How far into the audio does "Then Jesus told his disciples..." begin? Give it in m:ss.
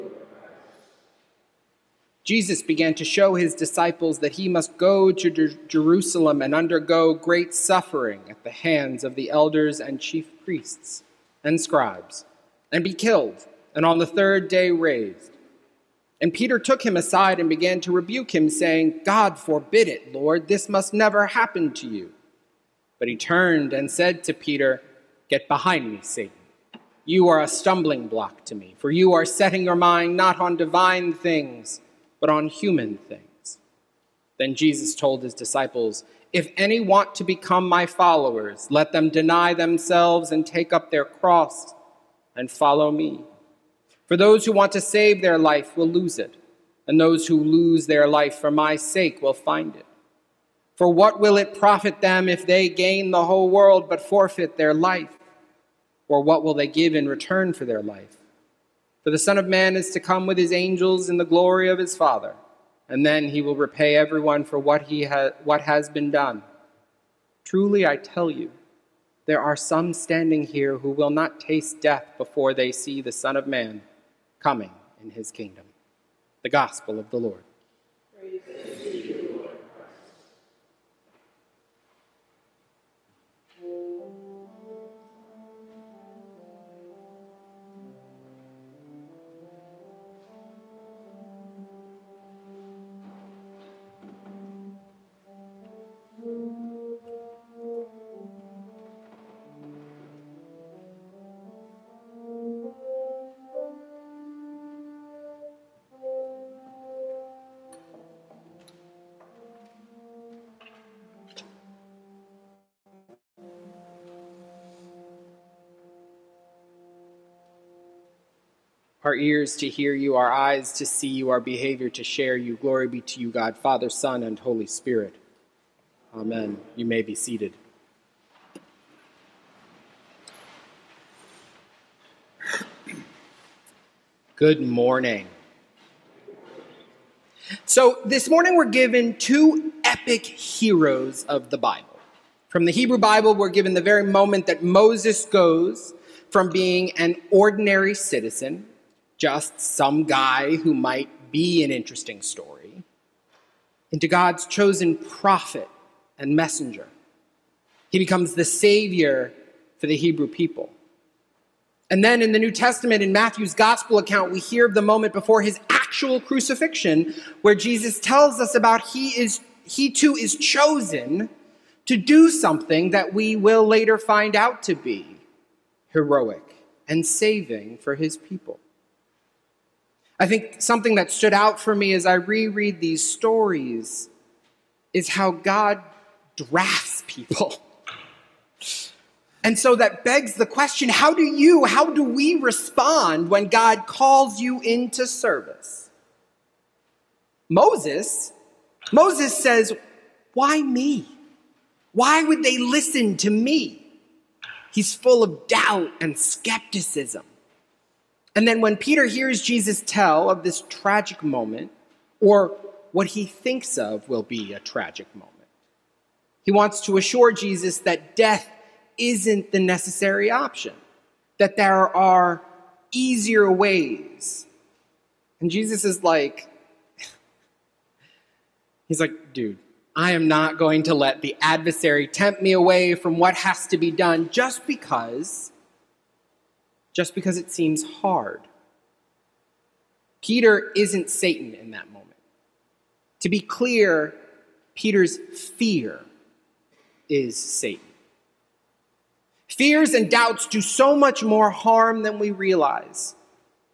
0:34.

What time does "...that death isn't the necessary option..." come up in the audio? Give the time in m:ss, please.
3:37.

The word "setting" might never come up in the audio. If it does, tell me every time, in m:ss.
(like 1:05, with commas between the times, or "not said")
0:29.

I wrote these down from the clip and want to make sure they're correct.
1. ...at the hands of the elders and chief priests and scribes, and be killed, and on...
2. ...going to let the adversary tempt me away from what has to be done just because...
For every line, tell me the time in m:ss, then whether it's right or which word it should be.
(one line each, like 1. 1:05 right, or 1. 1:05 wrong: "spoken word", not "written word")
1. 0:08 right
2. 3:50 right.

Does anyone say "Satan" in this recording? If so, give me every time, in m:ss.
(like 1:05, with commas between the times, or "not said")
0:26, 4:01, 4:07.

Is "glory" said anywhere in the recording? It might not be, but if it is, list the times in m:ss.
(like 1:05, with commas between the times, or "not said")
1:01, 2:02.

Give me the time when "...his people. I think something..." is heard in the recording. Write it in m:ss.
2:57.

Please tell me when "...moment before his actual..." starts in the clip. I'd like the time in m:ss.
2:44.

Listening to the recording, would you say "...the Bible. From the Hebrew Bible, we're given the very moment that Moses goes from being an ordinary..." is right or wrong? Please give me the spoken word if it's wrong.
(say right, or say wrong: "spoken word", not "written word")
right.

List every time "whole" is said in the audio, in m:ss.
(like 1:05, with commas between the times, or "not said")
0:53.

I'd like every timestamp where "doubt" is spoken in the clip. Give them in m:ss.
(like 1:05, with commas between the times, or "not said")
3:25, 4:10.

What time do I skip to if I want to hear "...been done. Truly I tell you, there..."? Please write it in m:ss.
1:05.